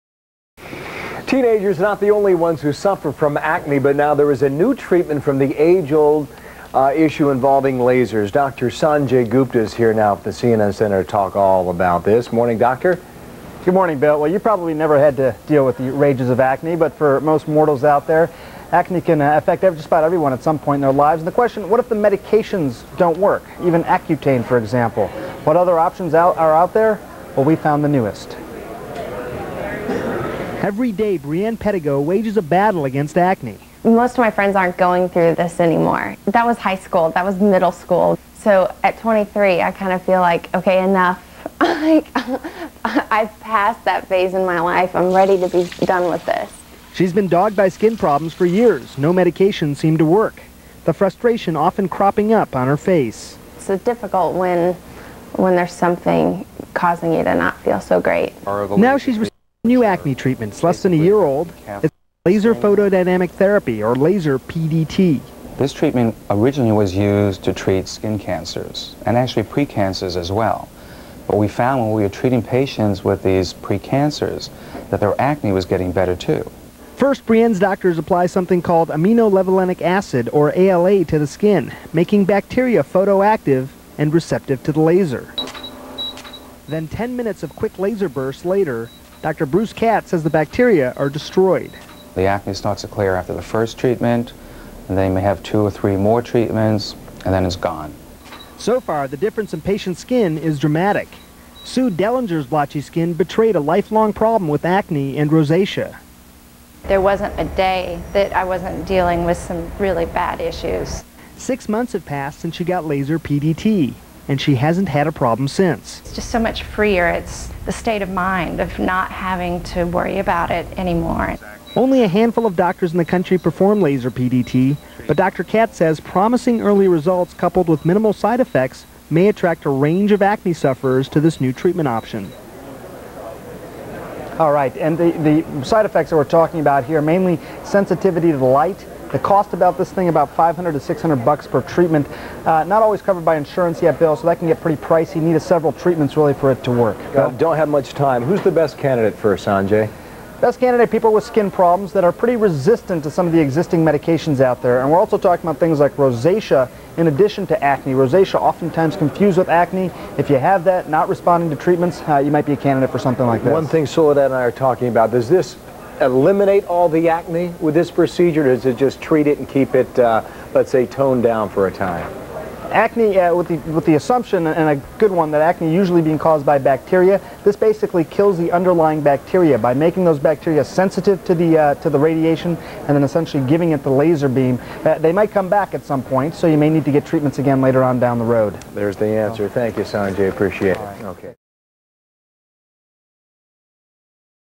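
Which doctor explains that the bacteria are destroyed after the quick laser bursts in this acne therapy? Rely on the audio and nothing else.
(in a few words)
Dr. Bruce Katz.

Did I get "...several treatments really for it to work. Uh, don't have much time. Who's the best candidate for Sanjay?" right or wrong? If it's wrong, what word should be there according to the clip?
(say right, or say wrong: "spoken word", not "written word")
right.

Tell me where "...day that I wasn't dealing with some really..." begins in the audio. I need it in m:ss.
1:47.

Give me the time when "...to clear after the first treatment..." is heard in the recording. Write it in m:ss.
1:32.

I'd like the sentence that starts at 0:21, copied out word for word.
And the question, what if the medications don't work?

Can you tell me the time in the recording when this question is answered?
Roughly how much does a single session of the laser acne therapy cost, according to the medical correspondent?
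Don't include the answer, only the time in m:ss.
2:20.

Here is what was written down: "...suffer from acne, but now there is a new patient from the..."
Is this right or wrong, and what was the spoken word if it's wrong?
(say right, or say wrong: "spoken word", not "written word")
wrong: "treatment", not "patient".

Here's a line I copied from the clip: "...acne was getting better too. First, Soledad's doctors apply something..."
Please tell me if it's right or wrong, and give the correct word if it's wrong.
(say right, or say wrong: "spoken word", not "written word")
wrong: "Brienne", not "Soledad".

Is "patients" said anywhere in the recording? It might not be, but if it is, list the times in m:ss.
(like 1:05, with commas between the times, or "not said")
1:12, 1:39.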